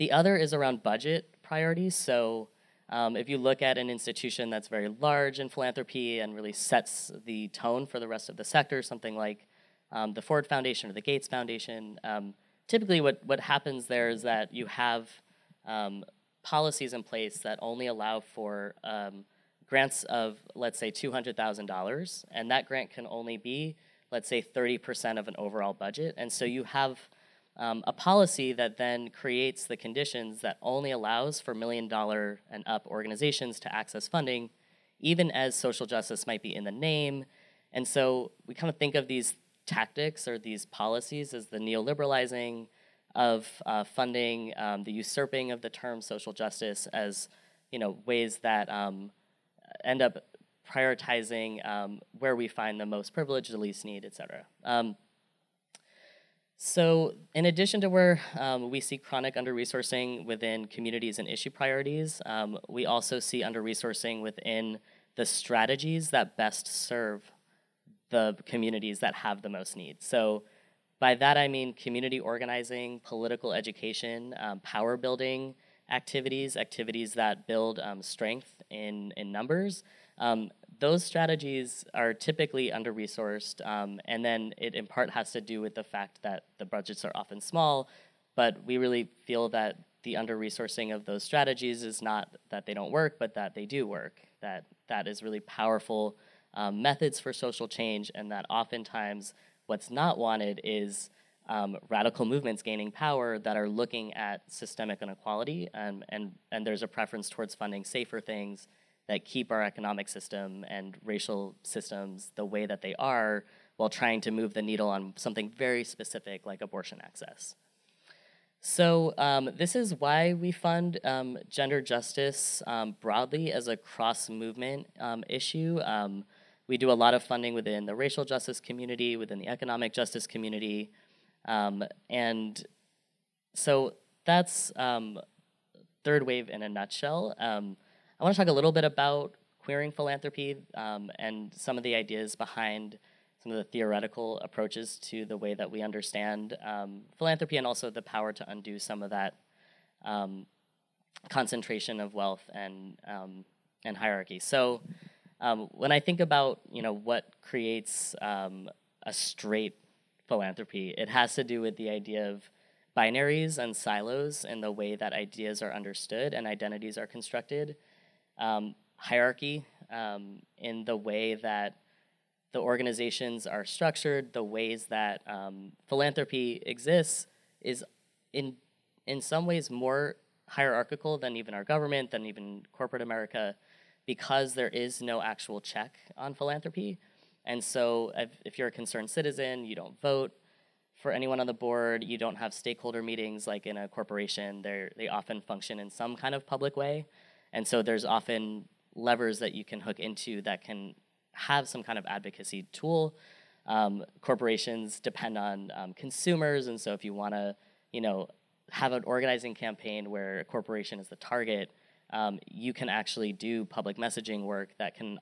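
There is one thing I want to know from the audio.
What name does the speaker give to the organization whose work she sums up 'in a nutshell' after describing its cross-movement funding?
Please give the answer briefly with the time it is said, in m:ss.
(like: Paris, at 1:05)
Third Wave, at 2:16.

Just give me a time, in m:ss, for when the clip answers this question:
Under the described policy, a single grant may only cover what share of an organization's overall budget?
0:24.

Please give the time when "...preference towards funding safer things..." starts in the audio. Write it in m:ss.
1:46.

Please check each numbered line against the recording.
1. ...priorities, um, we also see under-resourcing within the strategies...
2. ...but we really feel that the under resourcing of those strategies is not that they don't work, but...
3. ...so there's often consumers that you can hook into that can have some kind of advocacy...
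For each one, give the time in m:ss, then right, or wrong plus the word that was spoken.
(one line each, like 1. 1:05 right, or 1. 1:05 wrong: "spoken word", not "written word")
1. 1:01 right
2. 1:28 right
3. 3:17 wrong: "levers", not "consumers".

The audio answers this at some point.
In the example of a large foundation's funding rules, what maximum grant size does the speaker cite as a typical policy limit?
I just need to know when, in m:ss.
0:20.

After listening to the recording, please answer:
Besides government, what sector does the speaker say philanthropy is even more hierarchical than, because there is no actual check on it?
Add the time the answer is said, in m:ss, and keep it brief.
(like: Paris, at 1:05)
corporate America, at 3:02.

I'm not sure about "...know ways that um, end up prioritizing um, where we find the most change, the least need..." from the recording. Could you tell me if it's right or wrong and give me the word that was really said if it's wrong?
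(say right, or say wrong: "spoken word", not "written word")
wrong: "privilege", not "change".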